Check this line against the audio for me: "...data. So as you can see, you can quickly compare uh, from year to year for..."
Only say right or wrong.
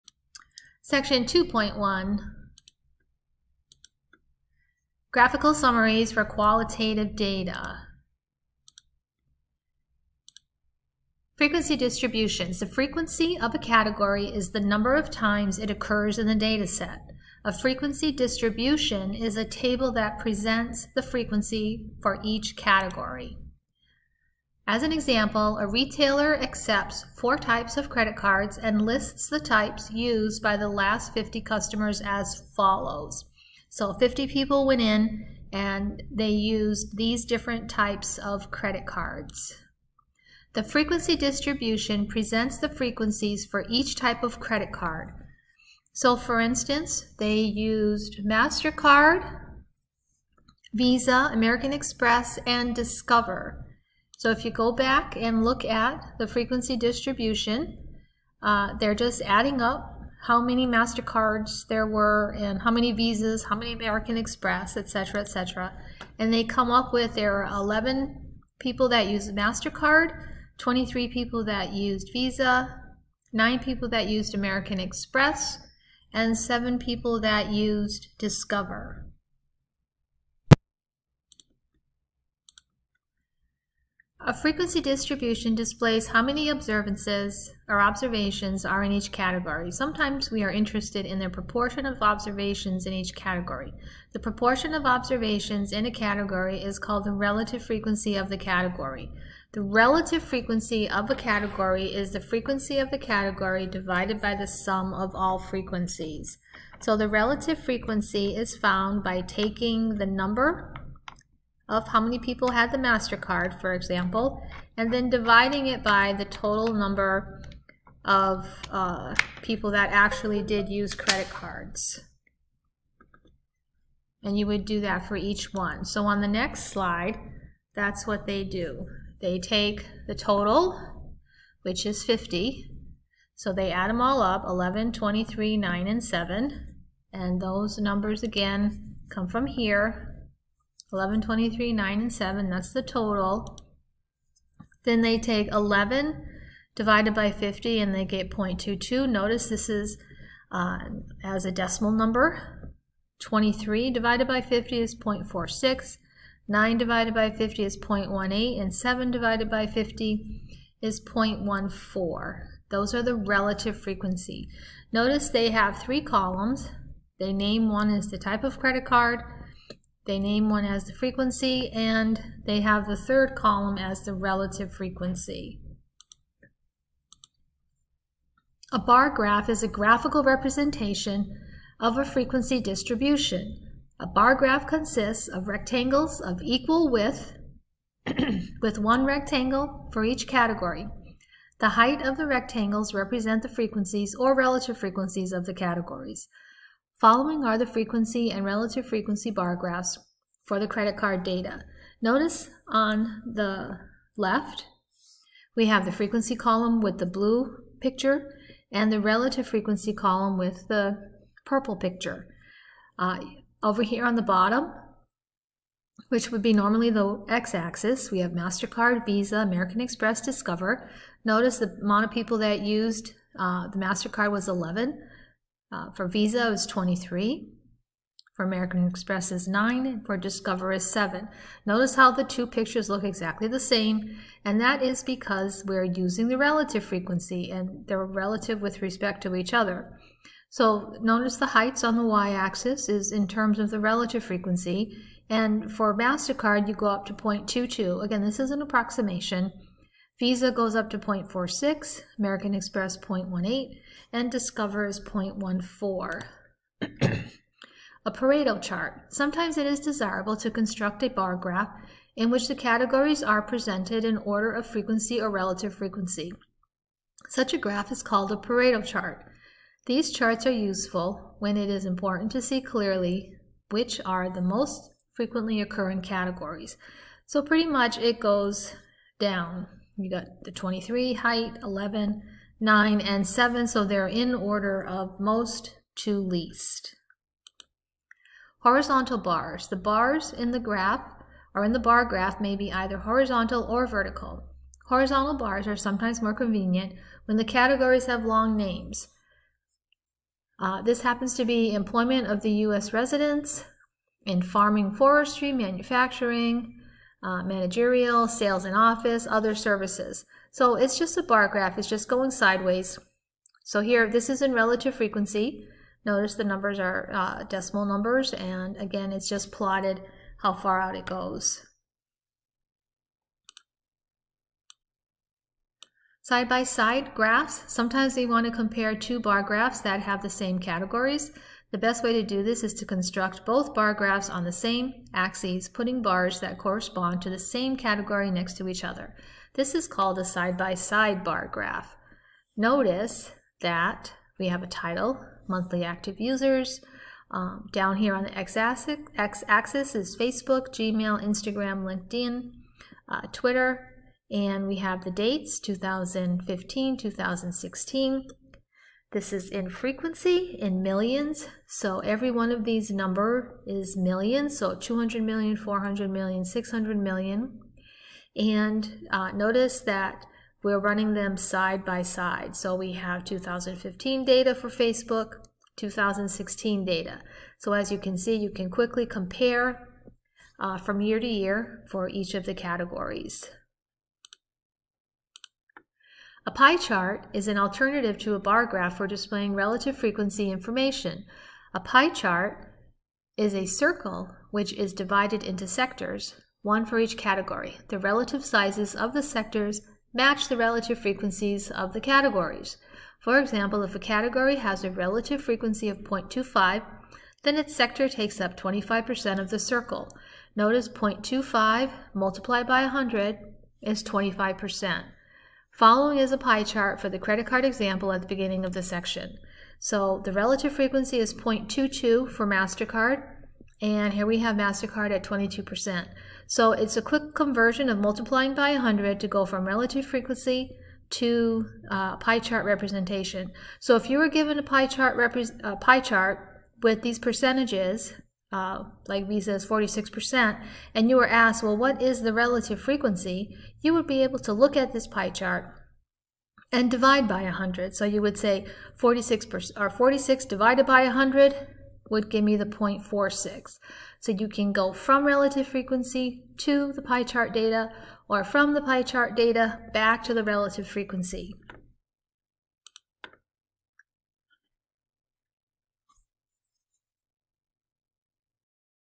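right.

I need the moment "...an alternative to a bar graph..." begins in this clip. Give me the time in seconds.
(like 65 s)
387 s.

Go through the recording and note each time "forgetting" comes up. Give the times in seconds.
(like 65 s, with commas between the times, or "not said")
not said.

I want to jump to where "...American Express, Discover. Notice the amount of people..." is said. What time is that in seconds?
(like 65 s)
219 s.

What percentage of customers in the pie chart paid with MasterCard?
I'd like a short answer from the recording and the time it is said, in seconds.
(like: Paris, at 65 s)
22%, at 425 s.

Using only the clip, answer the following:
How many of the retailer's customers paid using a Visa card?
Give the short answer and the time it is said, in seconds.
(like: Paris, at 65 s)
23, at 70 s.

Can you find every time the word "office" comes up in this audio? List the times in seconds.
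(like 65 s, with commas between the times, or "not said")
308 s.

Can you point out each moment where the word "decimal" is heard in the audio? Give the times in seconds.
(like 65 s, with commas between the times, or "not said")
151 s, 317 s.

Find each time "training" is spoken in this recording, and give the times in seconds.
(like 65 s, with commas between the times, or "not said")
not said.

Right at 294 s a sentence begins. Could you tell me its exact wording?
Horizontal bars are sometimes more convenient when the categories have long names.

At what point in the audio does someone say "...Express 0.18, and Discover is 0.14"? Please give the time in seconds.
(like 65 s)
252 s.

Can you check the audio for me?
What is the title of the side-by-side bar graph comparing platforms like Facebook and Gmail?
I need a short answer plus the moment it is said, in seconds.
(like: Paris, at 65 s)
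Monthly active users, at 345 s.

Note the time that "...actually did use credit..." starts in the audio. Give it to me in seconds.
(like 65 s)
119 s.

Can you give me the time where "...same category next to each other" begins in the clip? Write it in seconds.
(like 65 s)
337 s.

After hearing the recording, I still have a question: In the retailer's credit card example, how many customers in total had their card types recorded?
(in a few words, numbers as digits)
50.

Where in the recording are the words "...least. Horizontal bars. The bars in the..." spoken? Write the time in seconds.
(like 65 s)
286 s.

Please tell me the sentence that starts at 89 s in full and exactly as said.
Sometimes we are interested in the proportion of observations in each category.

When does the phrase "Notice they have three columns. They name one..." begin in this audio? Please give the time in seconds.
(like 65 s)
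164 s.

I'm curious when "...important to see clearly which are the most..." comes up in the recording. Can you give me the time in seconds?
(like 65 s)
271 s.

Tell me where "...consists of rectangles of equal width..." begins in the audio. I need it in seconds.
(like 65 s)
184 s.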